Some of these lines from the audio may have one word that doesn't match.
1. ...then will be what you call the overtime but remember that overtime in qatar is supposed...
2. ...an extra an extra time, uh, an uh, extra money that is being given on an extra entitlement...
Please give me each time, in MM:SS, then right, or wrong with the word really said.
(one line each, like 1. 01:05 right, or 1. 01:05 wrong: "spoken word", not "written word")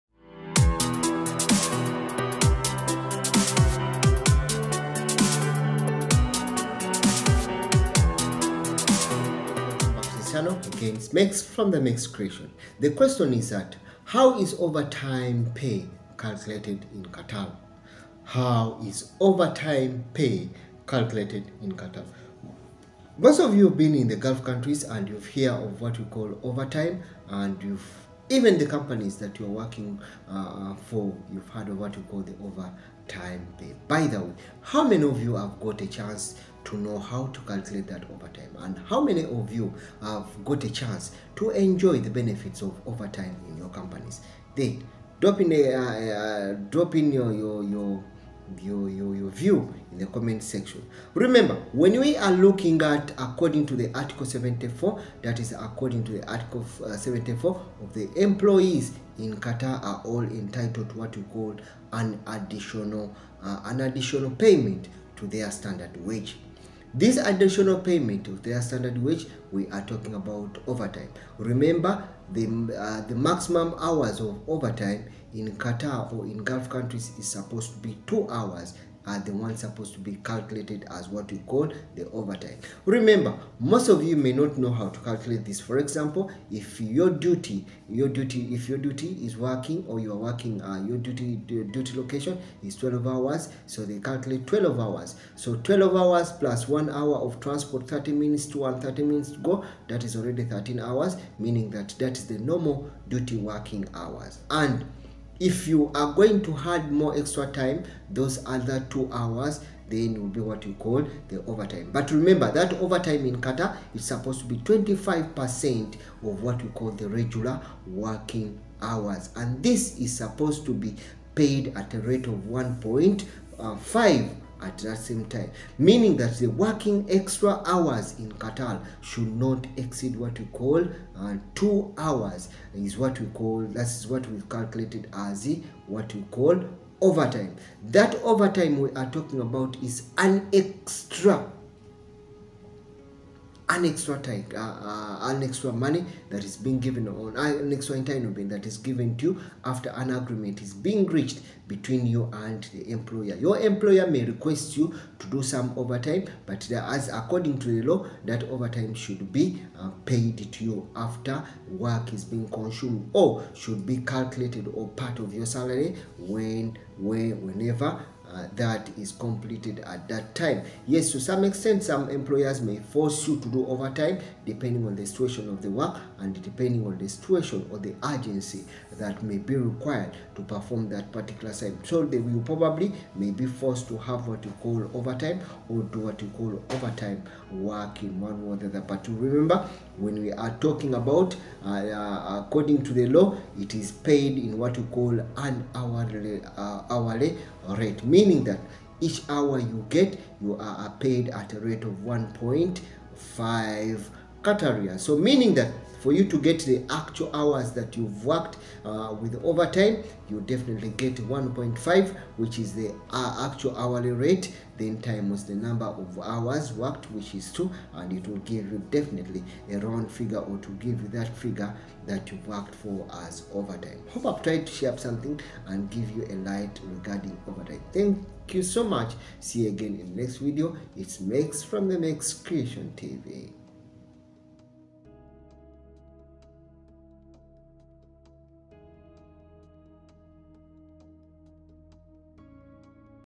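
1. 01:49 right
2. 02:20 right.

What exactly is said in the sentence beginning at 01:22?
Remember, most of you may not know how to calculate this.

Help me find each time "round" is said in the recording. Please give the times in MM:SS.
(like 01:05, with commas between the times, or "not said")
03:39.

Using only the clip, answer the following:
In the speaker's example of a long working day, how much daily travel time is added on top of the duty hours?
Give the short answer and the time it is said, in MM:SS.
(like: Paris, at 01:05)
1 hour, at 01:36.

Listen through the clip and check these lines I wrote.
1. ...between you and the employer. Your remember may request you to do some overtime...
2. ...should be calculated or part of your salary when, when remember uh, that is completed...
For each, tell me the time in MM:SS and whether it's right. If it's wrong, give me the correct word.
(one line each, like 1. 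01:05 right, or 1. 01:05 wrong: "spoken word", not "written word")
1. 02:31 wrong: "employer", not "remember"
2. 02:43 wrong: "whenever", not "remember".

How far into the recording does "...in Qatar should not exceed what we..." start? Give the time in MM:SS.
02:08.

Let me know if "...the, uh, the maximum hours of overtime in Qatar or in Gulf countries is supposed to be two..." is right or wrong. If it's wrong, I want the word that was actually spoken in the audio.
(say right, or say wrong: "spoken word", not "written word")
right.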